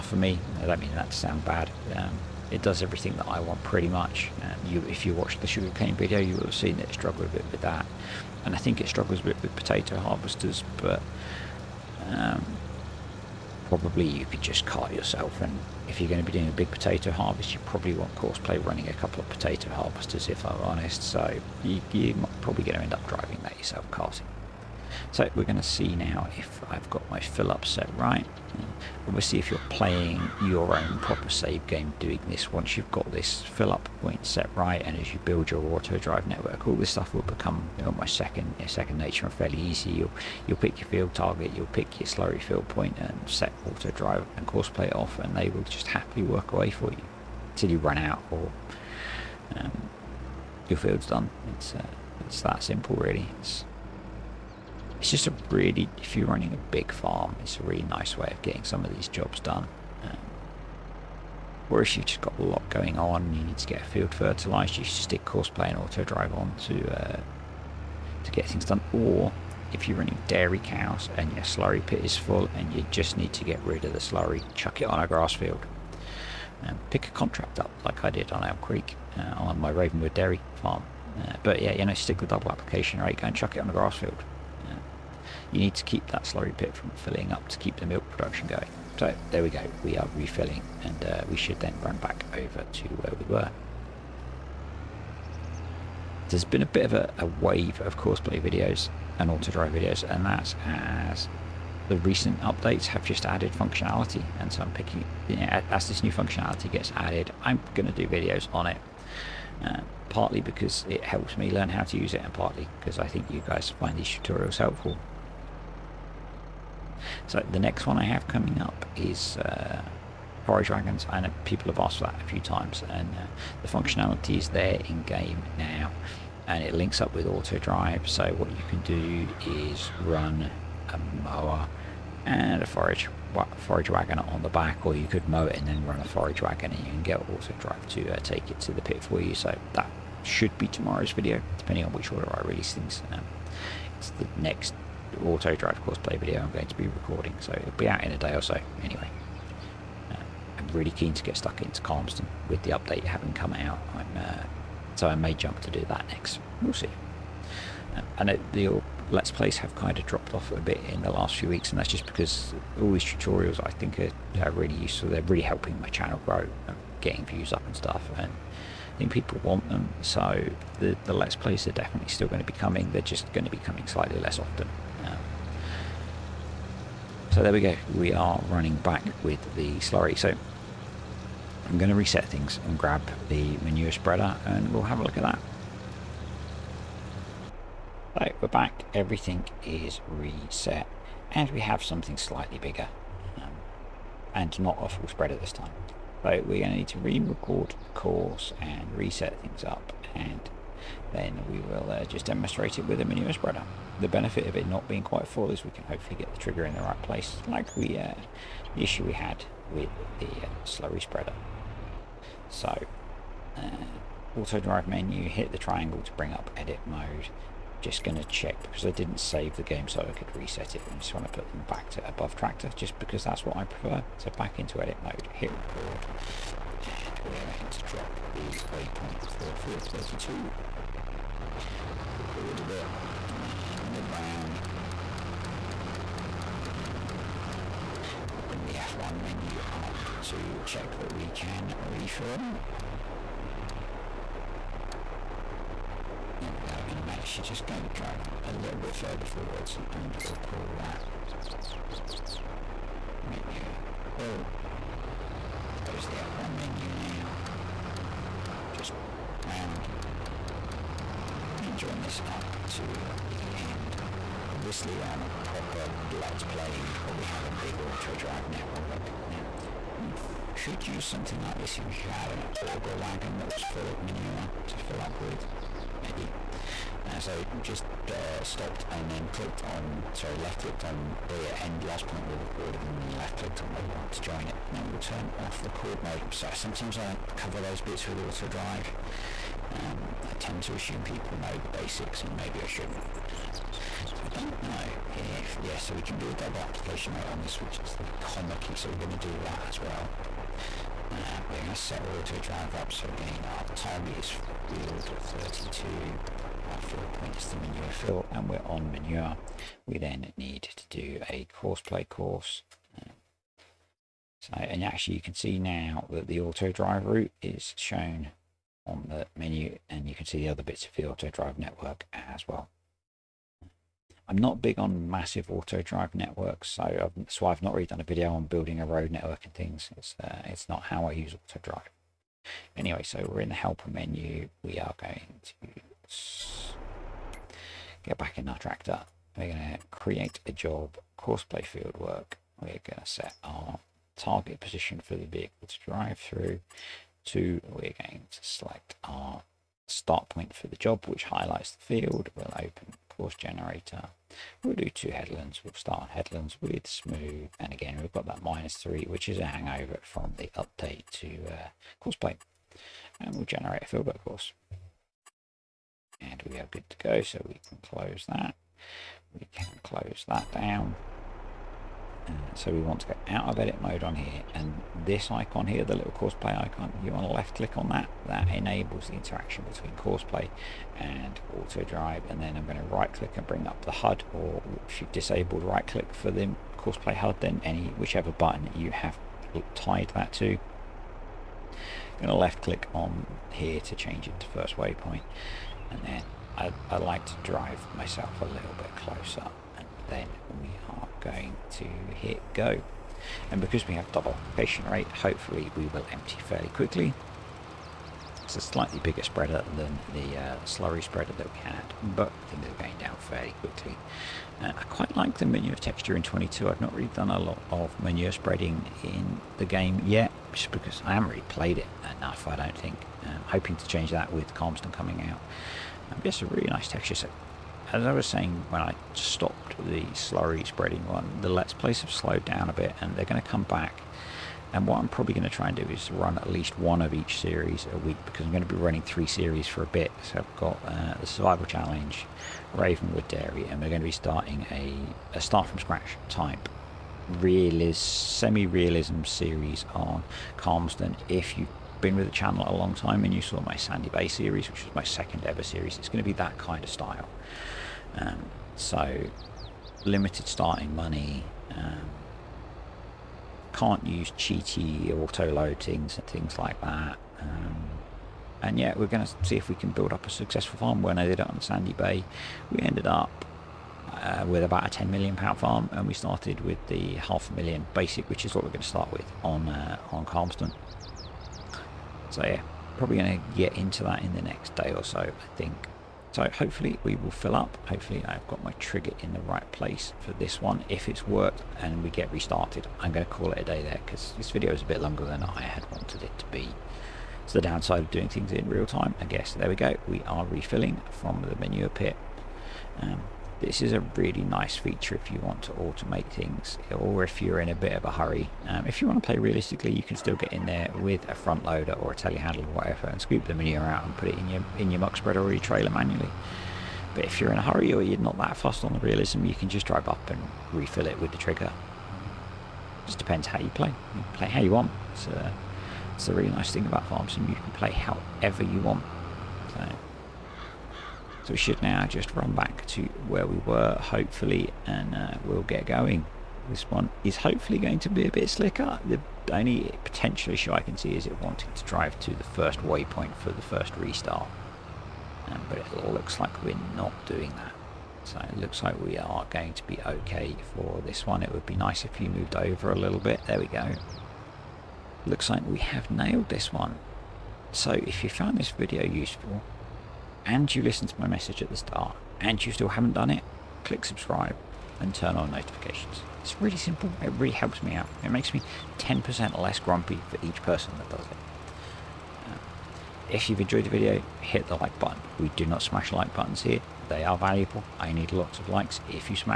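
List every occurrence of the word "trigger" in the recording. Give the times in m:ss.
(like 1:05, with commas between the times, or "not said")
3:26, 8:08, 8:41.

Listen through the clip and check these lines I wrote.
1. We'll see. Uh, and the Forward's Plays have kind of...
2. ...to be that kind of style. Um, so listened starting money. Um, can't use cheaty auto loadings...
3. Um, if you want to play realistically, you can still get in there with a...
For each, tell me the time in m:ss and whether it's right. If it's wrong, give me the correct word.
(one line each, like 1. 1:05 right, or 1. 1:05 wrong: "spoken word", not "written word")
1. 2:36 wrong: "Let", not "Forward"
2. 7:36 wrong: "limited", not "listened"
3. 8:28 right.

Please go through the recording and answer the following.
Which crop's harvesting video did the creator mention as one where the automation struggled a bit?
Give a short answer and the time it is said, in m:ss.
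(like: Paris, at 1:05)
Sugarcane, at 0:05.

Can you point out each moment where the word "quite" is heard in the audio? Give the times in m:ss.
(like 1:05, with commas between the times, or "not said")
3:25, 6:54.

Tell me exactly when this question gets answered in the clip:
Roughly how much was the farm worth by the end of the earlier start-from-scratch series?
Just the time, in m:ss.
7:54.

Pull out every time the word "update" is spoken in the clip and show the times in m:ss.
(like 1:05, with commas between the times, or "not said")
1:42, 2:32, 6:00.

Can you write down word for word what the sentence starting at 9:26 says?
It's really simple, it really helps me out.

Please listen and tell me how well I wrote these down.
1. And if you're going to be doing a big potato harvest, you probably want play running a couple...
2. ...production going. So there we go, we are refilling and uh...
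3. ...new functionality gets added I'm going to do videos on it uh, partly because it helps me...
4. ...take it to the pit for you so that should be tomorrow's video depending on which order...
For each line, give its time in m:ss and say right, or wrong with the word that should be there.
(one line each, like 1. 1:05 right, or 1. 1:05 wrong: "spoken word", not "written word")
1. 0:15 right
2. 1:28 right
3. 1:46 right
4. 2:18 right.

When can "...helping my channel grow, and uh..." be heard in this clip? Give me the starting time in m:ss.
2:45.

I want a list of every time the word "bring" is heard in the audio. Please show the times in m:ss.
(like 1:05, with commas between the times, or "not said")
3:36, 3:58, 6:23.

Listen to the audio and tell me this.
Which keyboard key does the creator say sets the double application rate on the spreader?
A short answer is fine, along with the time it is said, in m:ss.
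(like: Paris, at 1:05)
Comma, at 4:58.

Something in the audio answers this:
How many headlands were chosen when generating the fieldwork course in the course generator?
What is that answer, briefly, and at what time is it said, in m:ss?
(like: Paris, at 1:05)
Two, at 5:54.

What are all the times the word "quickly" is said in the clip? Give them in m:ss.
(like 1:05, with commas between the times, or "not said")
6:46, 6:53.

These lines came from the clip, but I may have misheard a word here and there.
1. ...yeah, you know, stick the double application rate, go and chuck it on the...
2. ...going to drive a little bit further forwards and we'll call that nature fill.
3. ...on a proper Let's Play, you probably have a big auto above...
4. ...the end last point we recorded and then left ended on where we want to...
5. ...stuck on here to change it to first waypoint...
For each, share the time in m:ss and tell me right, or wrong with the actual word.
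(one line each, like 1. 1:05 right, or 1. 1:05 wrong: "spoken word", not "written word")
1. 1:21 right
2. 4:07 wrong: "manure", not "nature"
3. 4:25 wrong: "drive", not "above"
4. 4:41 wrong: "clicked", not "ended"
5. 6:32 wrong: "click", not "stuck".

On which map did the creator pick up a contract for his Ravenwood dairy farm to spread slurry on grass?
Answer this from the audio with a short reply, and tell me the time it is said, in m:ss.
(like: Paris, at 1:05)
Elm Creek, at 1:18.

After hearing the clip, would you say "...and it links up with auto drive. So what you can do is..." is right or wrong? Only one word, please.
right.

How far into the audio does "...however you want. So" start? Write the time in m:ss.
8:47.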